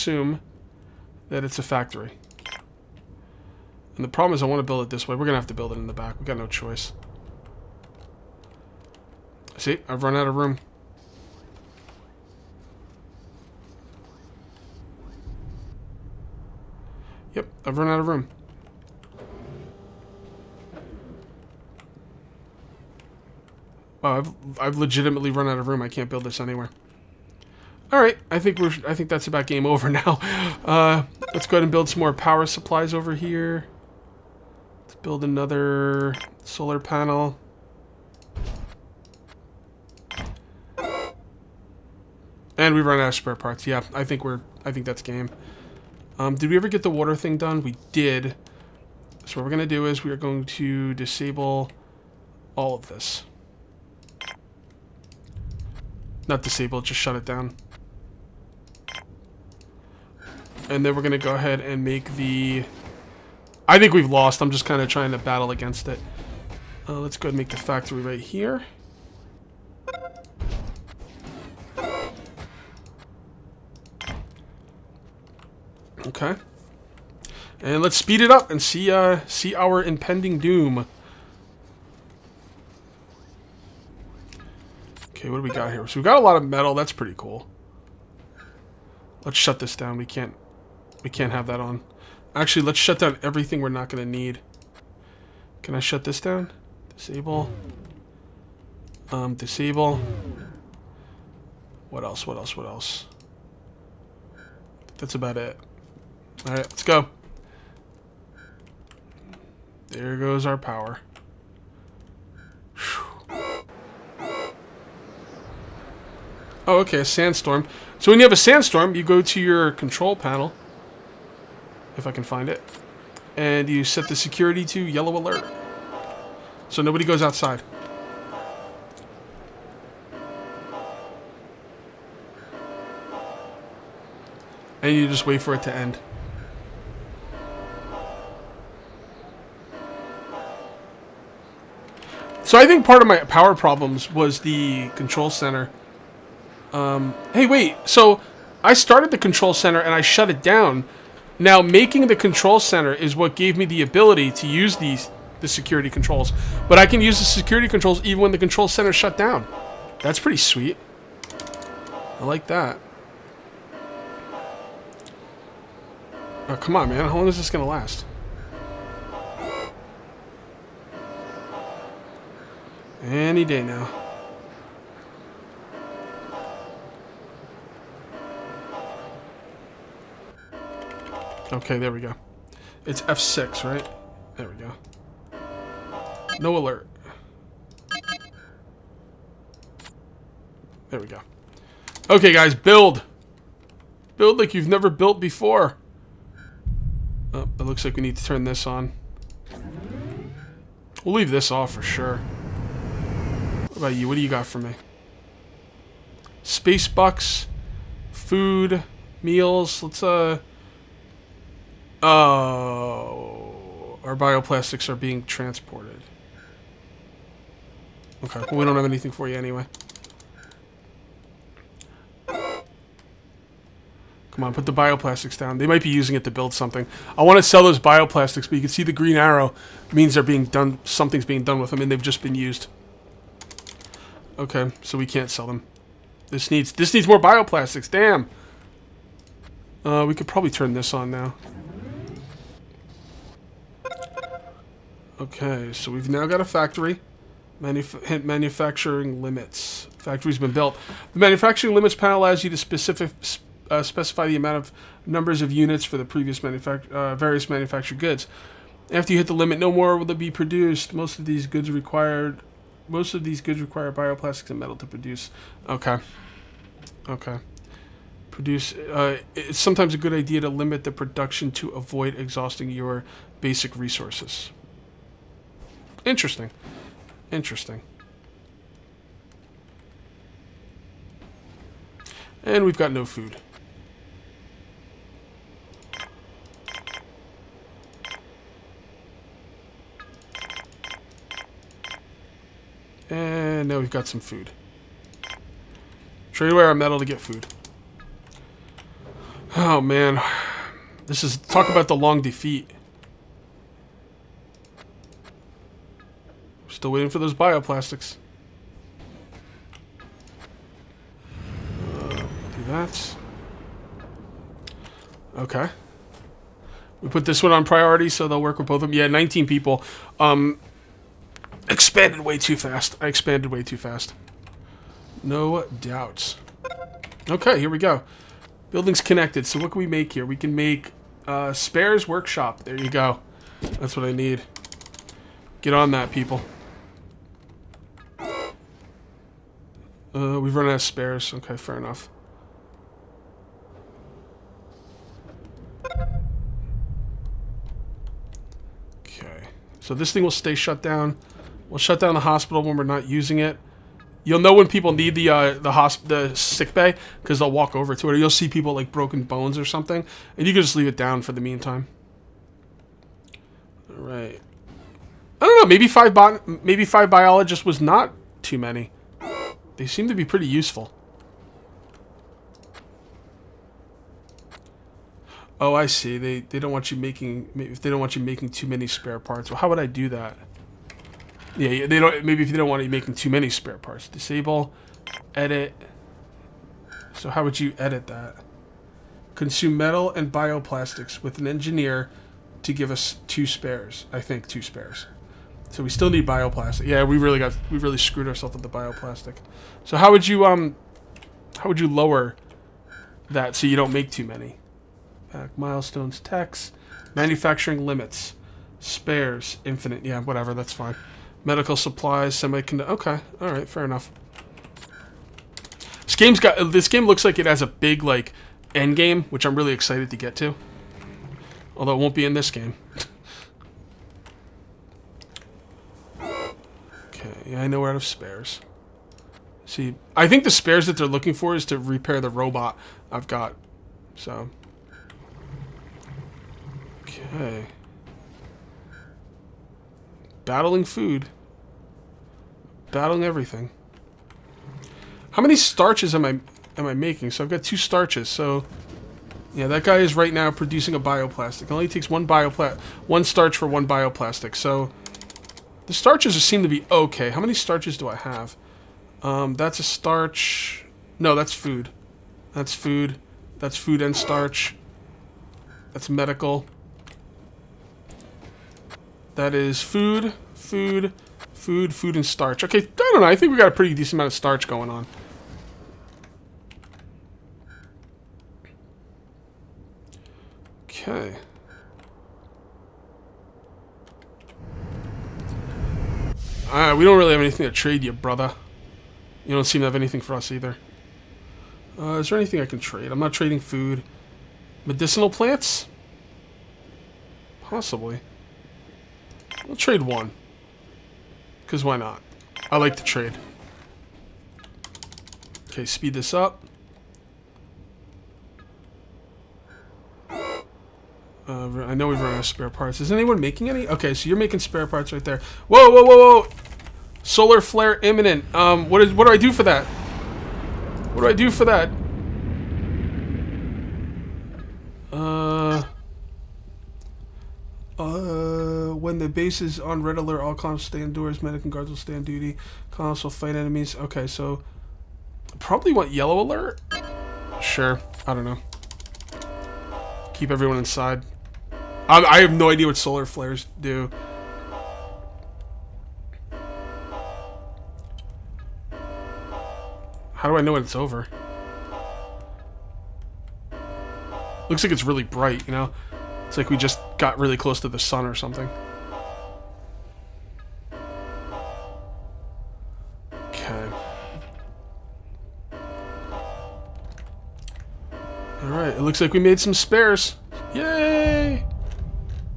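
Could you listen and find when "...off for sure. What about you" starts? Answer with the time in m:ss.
3:21.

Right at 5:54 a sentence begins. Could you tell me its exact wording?
You'll know when people need the uh, the hosp the sick bay because they'll walk over to it.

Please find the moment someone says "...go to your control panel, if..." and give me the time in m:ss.
1:59.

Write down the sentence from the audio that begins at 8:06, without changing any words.
Alright, we don't really have anything to trade you, brother.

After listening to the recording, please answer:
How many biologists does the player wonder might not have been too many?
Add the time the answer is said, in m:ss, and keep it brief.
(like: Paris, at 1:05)
5, at 6:06.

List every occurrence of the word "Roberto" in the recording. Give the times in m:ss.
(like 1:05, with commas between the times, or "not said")
not said.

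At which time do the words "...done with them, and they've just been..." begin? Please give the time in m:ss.
3:51.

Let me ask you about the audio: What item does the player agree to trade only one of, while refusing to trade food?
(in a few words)
Medicinal plants.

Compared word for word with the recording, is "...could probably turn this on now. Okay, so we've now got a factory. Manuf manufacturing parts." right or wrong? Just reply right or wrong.
wrong.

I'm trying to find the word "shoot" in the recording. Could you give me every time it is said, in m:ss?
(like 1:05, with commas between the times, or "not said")
not said.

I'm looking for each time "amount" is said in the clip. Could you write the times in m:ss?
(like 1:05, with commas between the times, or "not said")
4:14, 7:54.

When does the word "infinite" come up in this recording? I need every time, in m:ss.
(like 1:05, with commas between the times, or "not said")
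6:49.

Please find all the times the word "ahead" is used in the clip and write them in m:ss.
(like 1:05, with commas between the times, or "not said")
0:31, 1:01, 1:07.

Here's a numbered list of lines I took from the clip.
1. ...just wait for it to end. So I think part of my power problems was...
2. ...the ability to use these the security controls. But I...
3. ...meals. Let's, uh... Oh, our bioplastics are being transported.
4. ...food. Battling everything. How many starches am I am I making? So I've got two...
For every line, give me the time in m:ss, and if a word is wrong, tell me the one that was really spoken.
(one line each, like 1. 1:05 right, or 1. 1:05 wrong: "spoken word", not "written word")
1. 2:15 right
2. 2:33 right
3. 3:29 right
4. 7:20 right.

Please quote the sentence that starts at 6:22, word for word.
Maybe if they don't want you making too many spare parts, disable, edit.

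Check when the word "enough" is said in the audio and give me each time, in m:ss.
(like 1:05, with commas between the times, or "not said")
5:41, 6:53.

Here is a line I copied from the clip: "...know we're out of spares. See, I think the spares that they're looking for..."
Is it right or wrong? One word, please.
right.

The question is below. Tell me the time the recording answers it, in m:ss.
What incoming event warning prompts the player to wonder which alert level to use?
8:37.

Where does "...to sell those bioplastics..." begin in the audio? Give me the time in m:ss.
3:47.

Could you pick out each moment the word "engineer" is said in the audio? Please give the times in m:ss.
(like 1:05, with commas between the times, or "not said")
6:31.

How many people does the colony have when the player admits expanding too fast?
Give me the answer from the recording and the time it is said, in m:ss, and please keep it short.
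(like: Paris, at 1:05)
19, at 5:19.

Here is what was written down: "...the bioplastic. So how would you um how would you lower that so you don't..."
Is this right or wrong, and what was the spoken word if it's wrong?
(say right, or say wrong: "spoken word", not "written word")
right.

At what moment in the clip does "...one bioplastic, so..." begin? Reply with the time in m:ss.
7:33.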